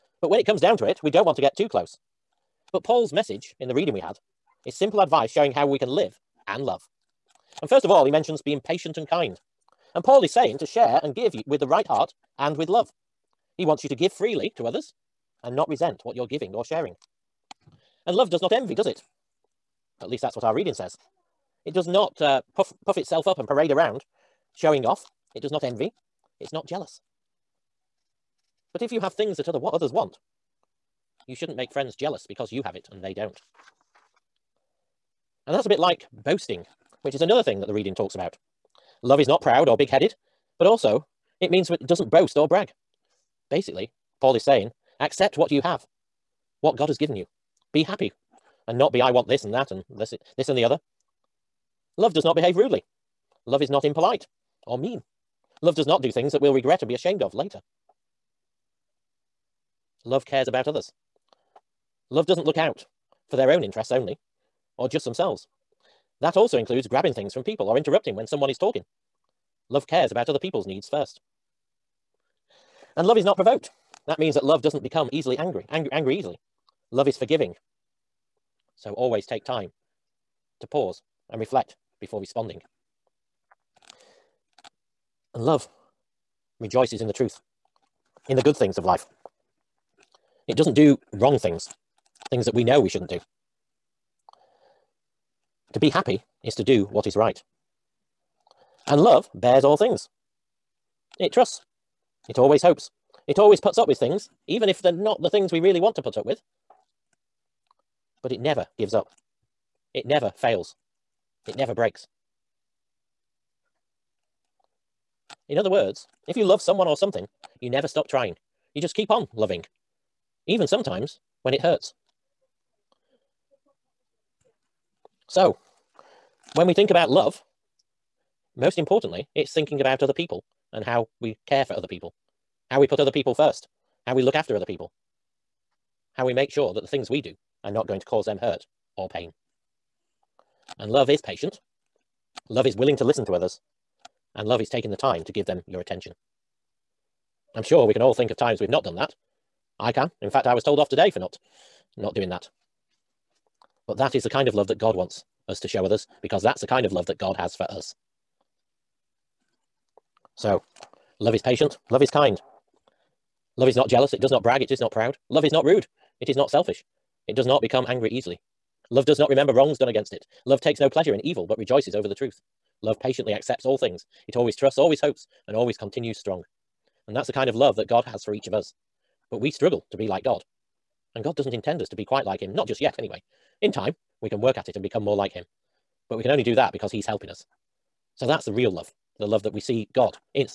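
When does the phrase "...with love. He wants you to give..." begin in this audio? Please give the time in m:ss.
0:12.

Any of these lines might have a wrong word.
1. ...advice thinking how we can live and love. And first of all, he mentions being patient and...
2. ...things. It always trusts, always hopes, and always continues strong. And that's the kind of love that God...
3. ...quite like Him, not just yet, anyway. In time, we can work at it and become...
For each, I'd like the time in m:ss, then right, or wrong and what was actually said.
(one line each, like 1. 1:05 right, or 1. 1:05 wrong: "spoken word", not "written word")
1. 0:04 wrong: "showing", not "thinking"
2. 2:53 right
3. 3:02 right.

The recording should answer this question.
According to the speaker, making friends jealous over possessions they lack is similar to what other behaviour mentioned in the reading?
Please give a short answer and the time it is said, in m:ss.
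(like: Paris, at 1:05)
Boasting, at 0:36.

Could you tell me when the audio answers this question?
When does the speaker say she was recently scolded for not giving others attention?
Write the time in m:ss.
2:30.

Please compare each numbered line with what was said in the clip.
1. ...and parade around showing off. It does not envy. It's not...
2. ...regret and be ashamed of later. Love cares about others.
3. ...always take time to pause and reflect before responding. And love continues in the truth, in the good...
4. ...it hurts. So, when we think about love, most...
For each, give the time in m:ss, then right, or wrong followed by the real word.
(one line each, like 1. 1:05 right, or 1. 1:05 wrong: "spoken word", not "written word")
1. 0:23 right
2. 0:56 right
3. 1:18 wrong: "rejoices", not "continues"
4. 2:01 right.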